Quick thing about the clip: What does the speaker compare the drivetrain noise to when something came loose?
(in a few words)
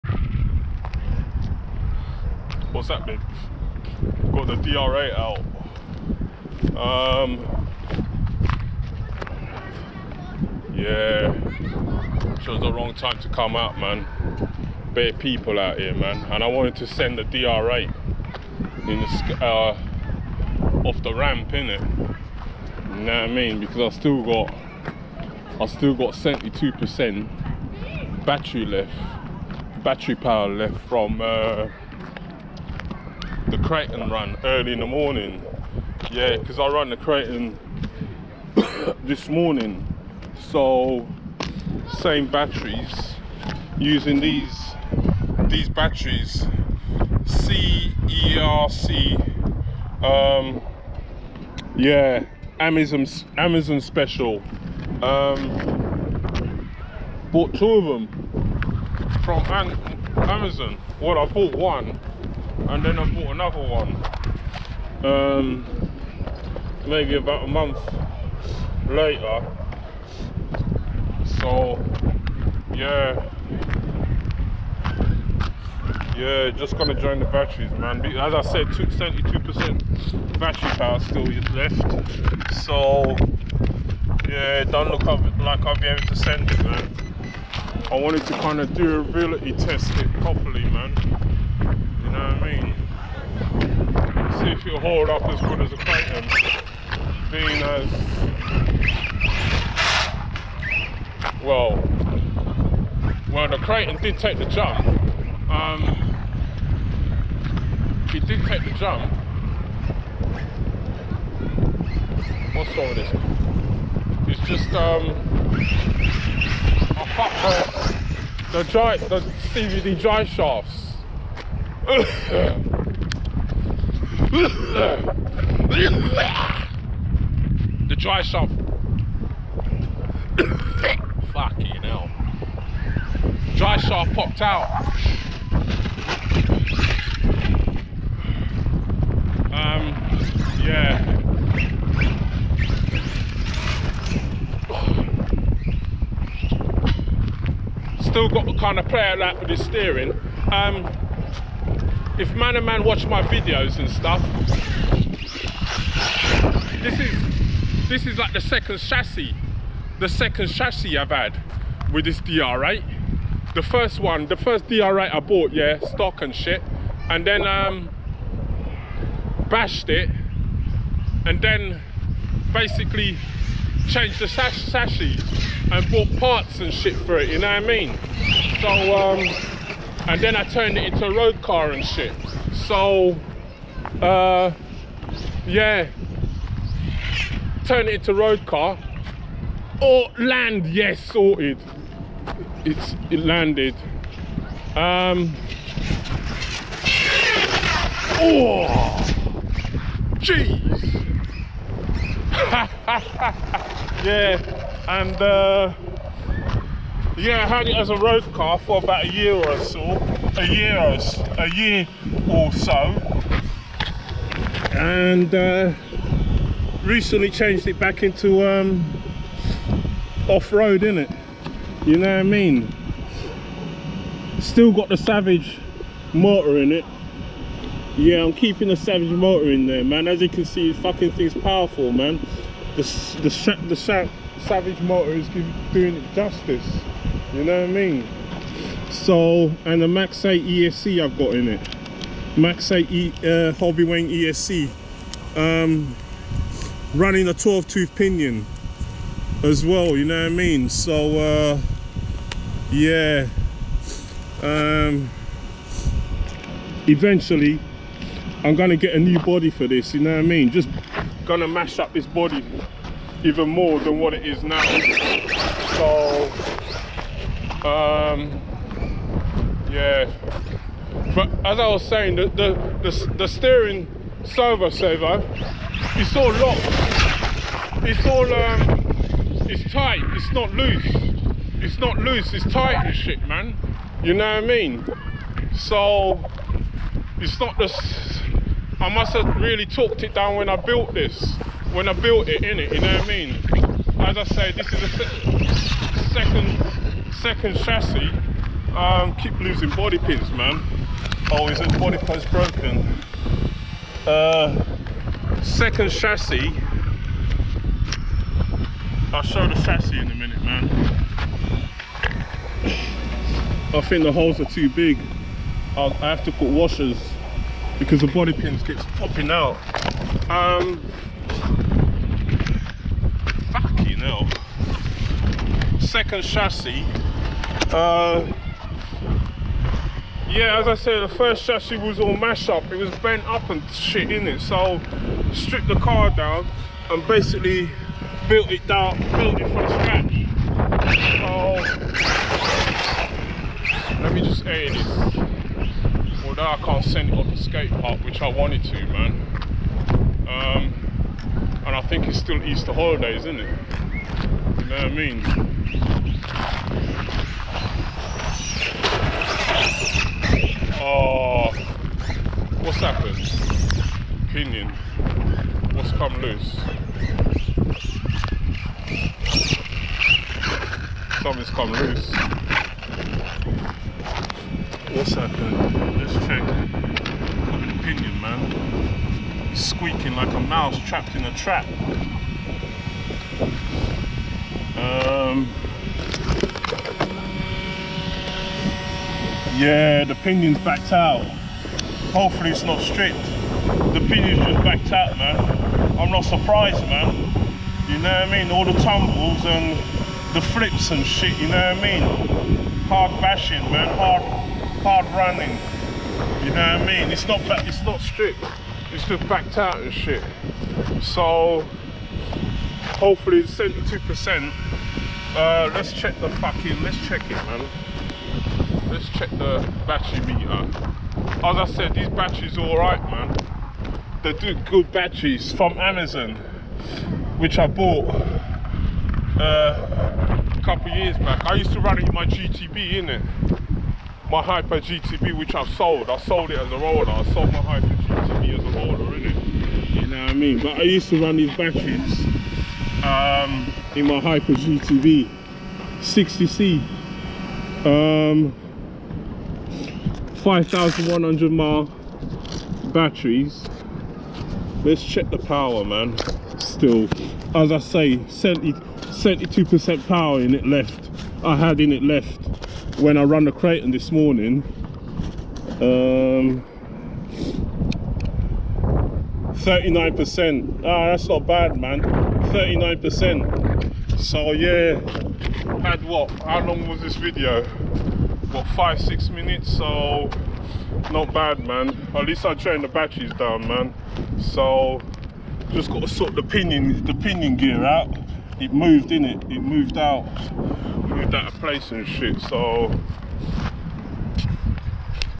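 a mouse trapped in a trap.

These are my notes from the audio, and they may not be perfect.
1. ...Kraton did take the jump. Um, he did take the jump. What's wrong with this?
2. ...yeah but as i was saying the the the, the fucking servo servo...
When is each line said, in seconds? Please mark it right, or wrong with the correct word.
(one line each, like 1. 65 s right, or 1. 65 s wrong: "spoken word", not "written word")
1. 103 s right
2. 269 s wrong: "steering", not "fucking".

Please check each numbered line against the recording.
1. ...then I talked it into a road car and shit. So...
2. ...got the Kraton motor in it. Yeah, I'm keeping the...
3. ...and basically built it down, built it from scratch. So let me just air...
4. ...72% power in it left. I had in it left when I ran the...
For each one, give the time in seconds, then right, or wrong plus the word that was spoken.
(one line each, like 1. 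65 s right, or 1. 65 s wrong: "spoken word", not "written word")
1. 180 s wrong: "turned", not "talked"
2. 224 s wrong: "Savage", not "Kraton"
3. 336 s right
4. 458 s right.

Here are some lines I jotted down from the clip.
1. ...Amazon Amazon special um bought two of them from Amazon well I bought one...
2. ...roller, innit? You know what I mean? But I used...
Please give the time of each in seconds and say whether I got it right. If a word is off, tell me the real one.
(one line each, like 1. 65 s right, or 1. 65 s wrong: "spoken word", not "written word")
1. 52 s right
2. 438 s right.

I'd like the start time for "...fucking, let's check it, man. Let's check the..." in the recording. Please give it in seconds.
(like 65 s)
416 s.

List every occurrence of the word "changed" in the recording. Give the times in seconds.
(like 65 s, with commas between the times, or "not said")
173 s, 217 s.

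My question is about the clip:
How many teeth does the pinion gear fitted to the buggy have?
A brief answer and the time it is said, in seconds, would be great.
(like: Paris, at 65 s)
12, at 247 s.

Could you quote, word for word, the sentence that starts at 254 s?
Um, eventually I'm gonna get a new body for this.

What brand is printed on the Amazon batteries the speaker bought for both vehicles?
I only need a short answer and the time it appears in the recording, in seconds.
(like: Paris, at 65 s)
CERC, at 47 s.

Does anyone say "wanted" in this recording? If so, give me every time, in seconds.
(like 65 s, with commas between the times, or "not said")
16 s, 87 s, 348 s.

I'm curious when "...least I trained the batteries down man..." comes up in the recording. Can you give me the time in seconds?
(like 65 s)
482 s.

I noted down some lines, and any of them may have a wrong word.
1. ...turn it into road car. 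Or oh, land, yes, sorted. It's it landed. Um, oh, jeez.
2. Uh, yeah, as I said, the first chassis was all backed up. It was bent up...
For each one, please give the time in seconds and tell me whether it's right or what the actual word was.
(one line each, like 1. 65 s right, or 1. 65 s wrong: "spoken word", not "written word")
1. 187 s right
2. 327 s wrong: "mashed", not "backed".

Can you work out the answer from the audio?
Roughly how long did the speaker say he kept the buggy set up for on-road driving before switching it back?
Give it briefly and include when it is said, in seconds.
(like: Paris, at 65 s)
about a year, at 208 s.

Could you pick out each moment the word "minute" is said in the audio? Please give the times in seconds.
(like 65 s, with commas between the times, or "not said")
310 s, 479 s.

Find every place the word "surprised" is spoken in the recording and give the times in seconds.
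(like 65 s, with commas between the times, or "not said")
396 s.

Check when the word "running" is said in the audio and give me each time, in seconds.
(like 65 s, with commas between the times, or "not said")
246 s, 405 s.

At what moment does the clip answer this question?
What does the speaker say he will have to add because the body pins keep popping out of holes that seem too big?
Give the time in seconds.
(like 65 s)
316 s.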